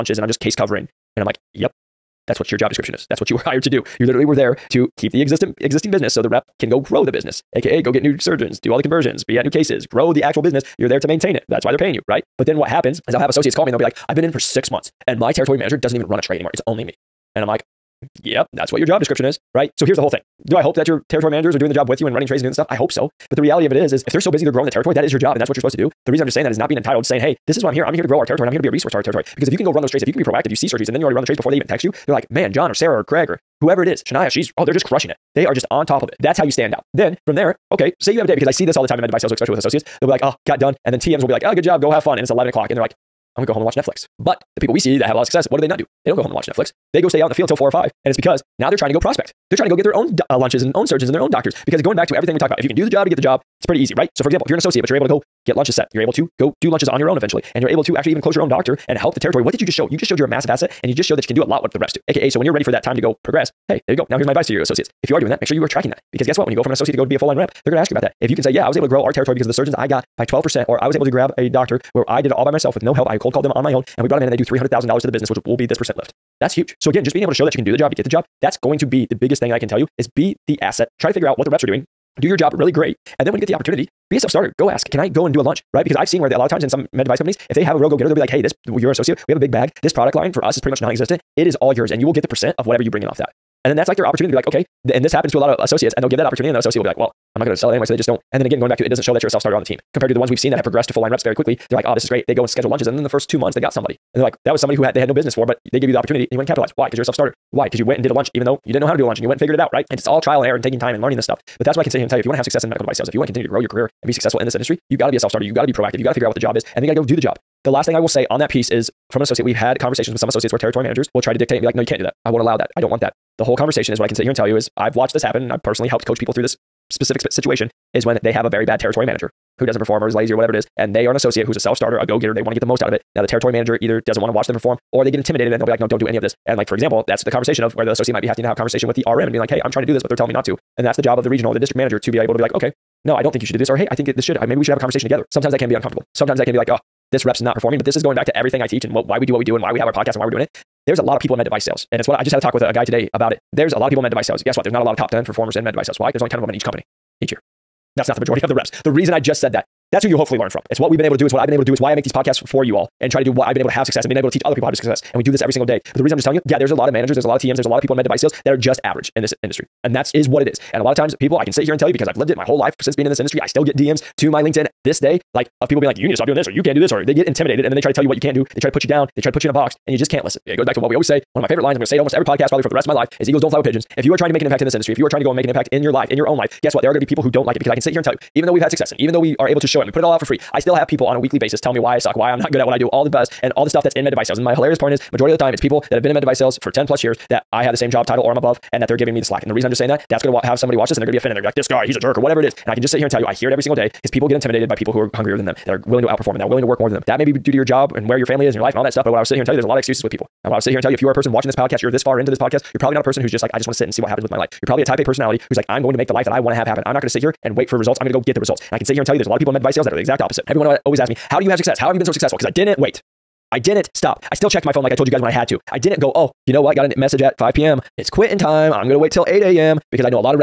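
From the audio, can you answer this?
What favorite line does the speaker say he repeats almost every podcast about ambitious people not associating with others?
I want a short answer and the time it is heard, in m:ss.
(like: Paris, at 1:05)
Eagles don't fly with pigeons, at 3:03.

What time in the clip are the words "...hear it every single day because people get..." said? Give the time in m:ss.
3:23.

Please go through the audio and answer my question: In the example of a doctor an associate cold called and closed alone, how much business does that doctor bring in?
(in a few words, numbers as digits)
$300,000.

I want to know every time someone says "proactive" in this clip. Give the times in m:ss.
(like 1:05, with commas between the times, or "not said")
0:30, 1:55.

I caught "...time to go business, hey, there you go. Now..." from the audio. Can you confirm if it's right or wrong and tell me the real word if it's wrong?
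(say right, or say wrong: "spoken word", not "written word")
wrong: "progress", not "business".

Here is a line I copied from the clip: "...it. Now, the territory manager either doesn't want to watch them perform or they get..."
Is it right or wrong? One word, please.
right.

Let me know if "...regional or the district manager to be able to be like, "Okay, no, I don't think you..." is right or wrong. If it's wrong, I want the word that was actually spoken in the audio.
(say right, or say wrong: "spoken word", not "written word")
right.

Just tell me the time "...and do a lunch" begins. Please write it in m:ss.
1:25.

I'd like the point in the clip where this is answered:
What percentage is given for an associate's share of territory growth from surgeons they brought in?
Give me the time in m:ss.
1:10.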